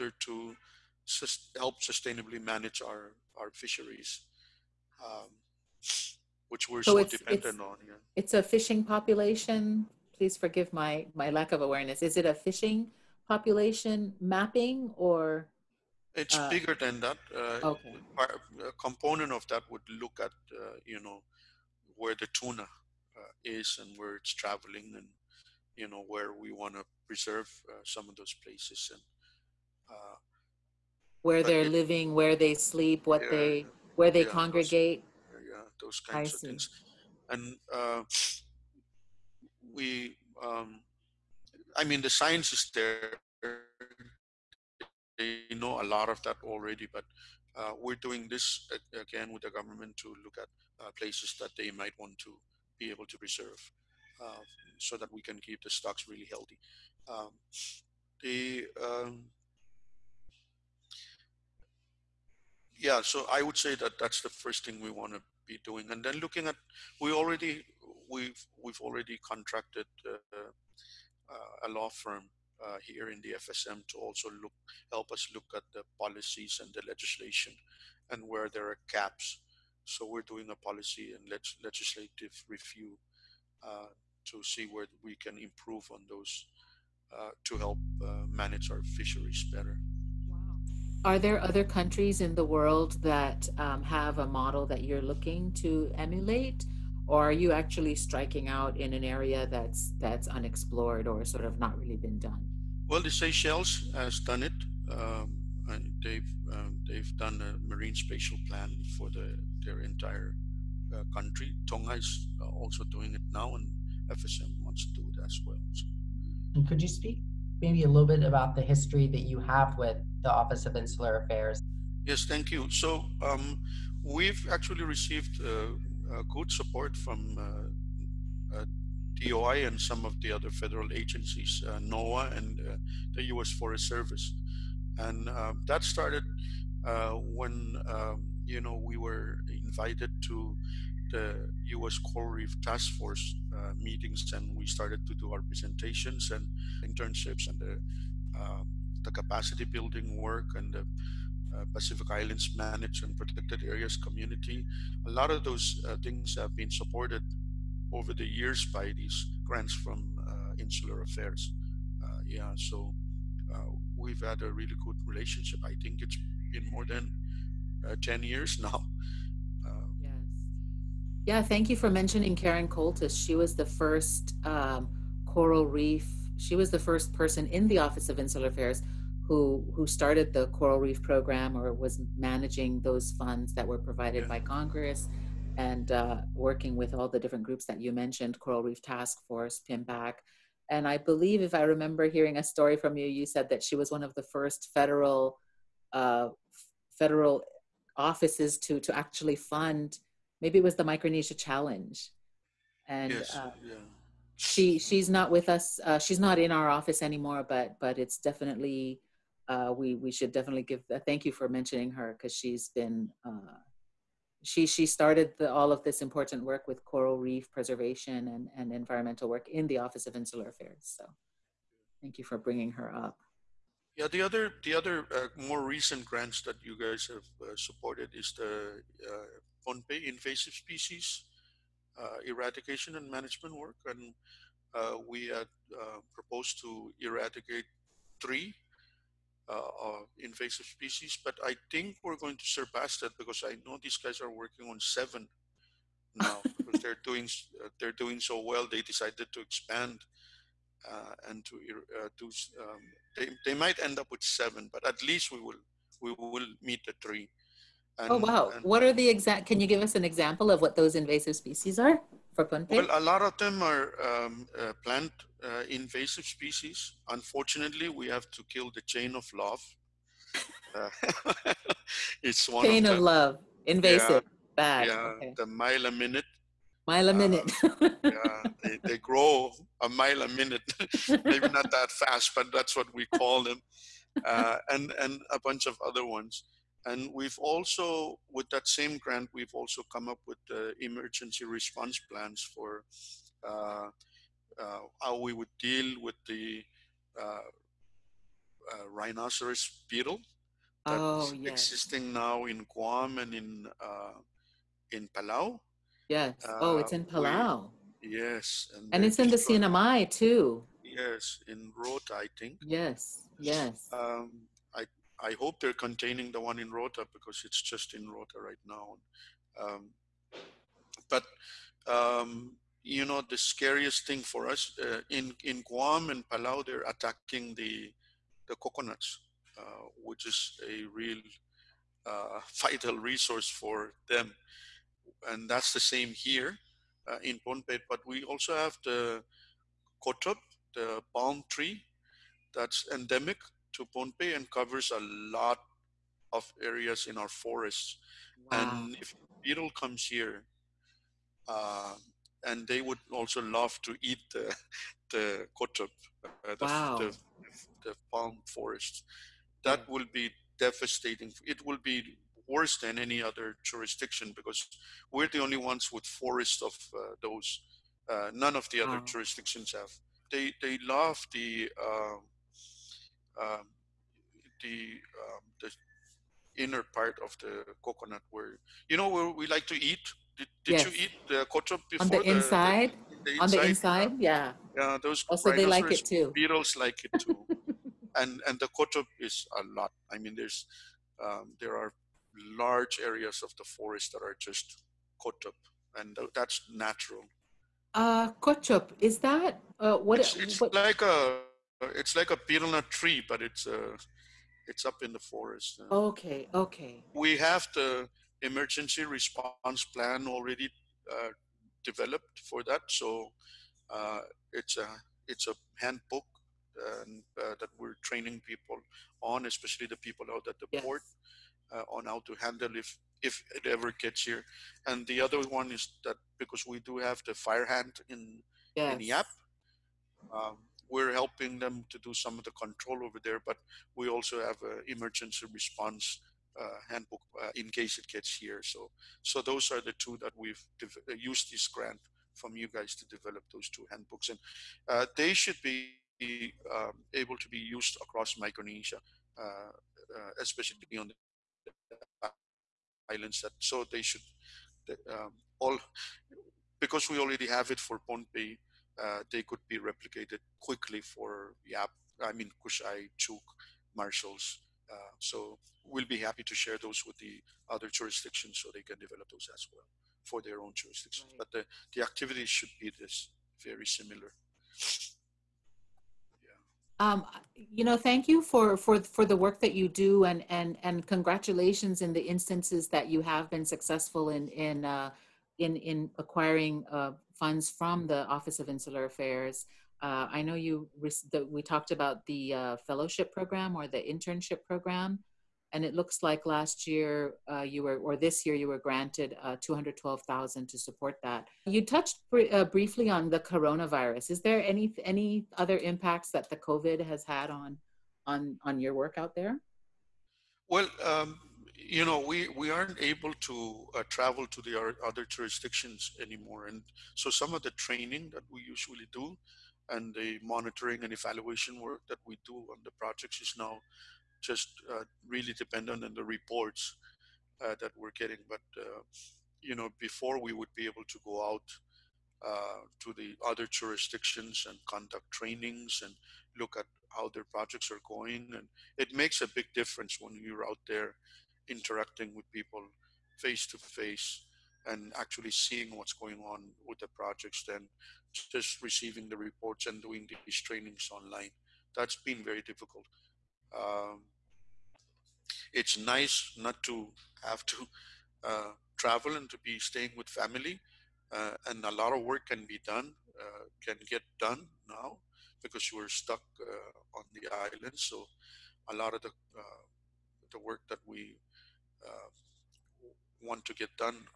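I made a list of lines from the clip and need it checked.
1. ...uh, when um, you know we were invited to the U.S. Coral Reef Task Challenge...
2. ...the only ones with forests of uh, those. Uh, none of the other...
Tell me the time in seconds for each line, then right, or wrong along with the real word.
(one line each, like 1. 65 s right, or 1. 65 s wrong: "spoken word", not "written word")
1. 136 s wrong: "Force", not "Challenge"
2. 365 s right.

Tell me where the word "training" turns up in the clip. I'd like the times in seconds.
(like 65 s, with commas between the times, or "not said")
418 s, 517 s, 535 s, 550 s.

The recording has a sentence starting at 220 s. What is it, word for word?
So thank you for bringing her up.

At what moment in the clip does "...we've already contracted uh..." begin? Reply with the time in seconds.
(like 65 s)
68 s.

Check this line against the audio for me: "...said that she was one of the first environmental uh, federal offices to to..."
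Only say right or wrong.
wrong.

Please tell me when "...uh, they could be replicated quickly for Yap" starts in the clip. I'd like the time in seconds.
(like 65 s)
459 s.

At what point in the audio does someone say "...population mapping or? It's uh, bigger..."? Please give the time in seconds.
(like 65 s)
13 s.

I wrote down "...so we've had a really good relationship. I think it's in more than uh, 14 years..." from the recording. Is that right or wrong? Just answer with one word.
wrong.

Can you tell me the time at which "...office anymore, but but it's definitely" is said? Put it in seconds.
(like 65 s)
206 s.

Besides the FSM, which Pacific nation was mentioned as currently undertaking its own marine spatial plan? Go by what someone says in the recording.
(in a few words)
Tonga.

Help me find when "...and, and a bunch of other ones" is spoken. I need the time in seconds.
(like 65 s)
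284 s.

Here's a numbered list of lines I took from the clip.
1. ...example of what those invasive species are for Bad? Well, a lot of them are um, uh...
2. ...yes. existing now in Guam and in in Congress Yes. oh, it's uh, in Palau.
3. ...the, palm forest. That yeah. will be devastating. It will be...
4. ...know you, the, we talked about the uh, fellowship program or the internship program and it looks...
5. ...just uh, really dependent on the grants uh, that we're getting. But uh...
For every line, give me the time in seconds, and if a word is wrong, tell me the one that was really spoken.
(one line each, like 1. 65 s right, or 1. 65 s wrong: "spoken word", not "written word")
1. 260 s wrong: "Pohnpei", not "Bad"
2. 301 s wrong: "Palau", not "Congress"
3. 357 s right
4. 490 s right
5. 524 s wrong: "reports", not "grants".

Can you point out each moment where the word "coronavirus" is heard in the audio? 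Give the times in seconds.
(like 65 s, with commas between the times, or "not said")
503 s.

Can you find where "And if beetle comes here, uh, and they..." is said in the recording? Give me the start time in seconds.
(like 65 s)
348 s.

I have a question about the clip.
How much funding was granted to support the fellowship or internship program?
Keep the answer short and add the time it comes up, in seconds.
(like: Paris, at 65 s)
212000, at 499 s.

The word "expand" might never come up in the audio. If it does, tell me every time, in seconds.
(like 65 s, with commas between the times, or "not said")
249 s.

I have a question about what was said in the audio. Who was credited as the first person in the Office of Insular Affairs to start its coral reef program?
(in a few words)
Karen Koltes.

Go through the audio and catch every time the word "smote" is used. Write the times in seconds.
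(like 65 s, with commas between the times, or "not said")
not said.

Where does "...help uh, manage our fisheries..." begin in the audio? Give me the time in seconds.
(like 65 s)
87 s.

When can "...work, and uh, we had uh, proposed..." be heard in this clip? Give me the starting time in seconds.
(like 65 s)
233 s.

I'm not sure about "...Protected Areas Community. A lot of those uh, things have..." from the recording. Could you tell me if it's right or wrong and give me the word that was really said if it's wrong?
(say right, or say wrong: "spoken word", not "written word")
right.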